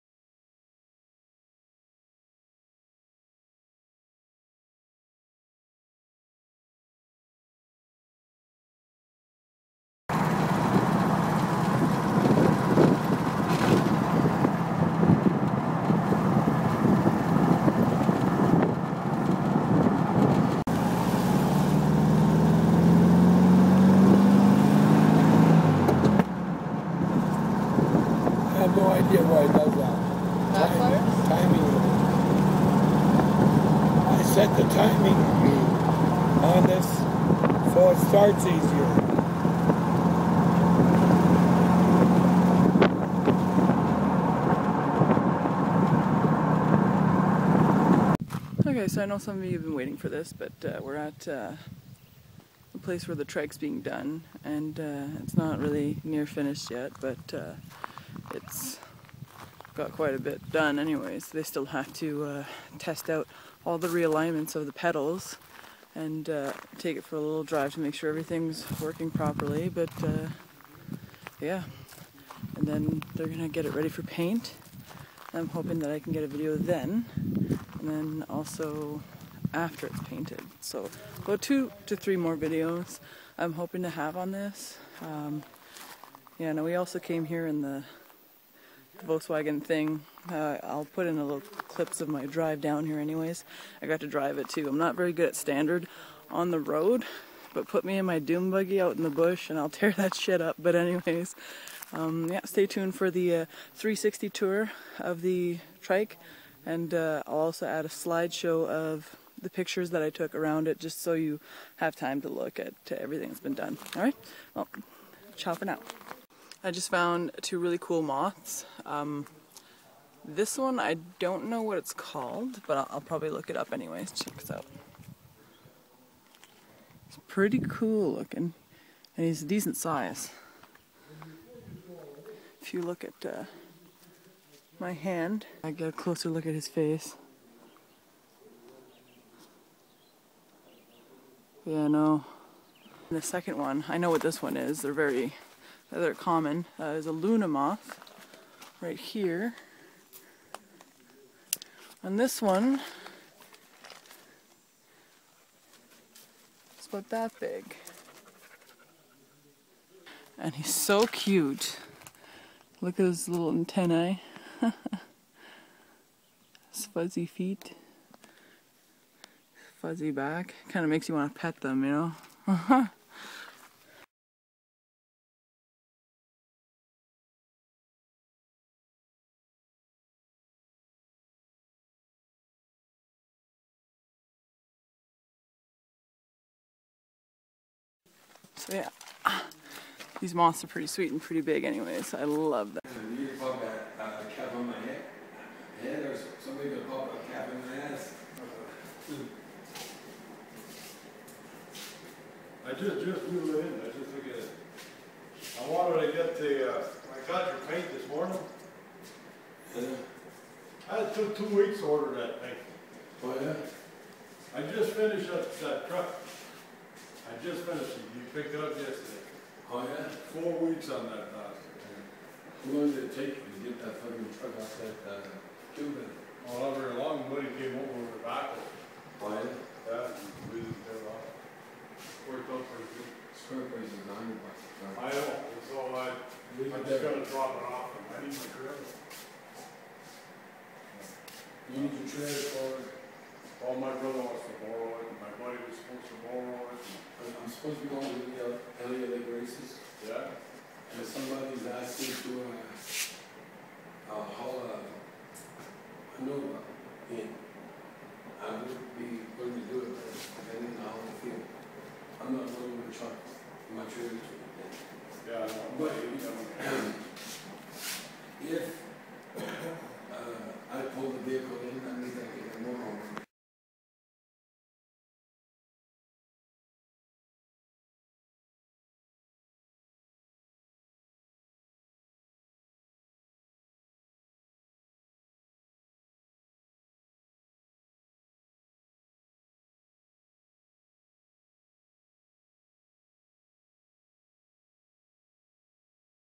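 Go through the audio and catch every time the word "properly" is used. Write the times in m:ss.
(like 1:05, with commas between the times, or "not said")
1:09.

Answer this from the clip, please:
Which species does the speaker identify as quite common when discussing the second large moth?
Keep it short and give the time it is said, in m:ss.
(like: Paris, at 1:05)
Luna moth, at 2:27.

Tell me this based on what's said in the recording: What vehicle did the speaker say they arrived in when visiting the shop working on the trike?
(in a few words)
Volkswagen.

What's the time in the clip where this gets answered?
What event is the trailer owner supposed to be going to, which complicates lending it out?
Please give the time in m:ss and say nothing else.
4:08.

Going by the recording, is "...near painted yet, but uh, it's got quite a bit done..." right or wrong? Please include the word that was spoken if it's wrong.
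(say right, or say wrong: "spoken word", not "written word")
wrong: "finished", not "painted".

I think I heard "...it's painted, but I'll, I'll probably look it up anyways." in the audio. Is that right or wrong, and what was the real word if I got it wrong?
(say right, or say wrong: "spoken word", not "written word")
wrong: "called", not "painted".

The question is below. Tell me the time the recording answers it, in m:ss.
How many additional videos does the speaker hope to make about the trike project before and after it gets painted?
1:21.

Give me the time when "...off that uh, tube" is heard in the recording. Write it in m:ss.
3:44.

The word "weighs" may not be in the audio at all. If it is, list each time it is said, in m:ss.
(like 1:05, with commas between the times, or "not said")
3:53.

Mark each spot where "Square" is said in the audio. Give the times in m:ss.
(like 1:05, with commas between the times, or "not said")
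3:53.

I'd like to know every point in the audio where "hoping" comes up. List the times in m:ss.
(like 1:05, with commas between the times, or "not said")
1:15, 1:23.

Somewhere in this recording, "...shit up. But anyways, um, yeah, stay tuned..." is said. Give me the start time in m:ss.
1:40.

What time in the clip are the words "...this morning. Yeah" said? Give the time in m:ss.
3:27.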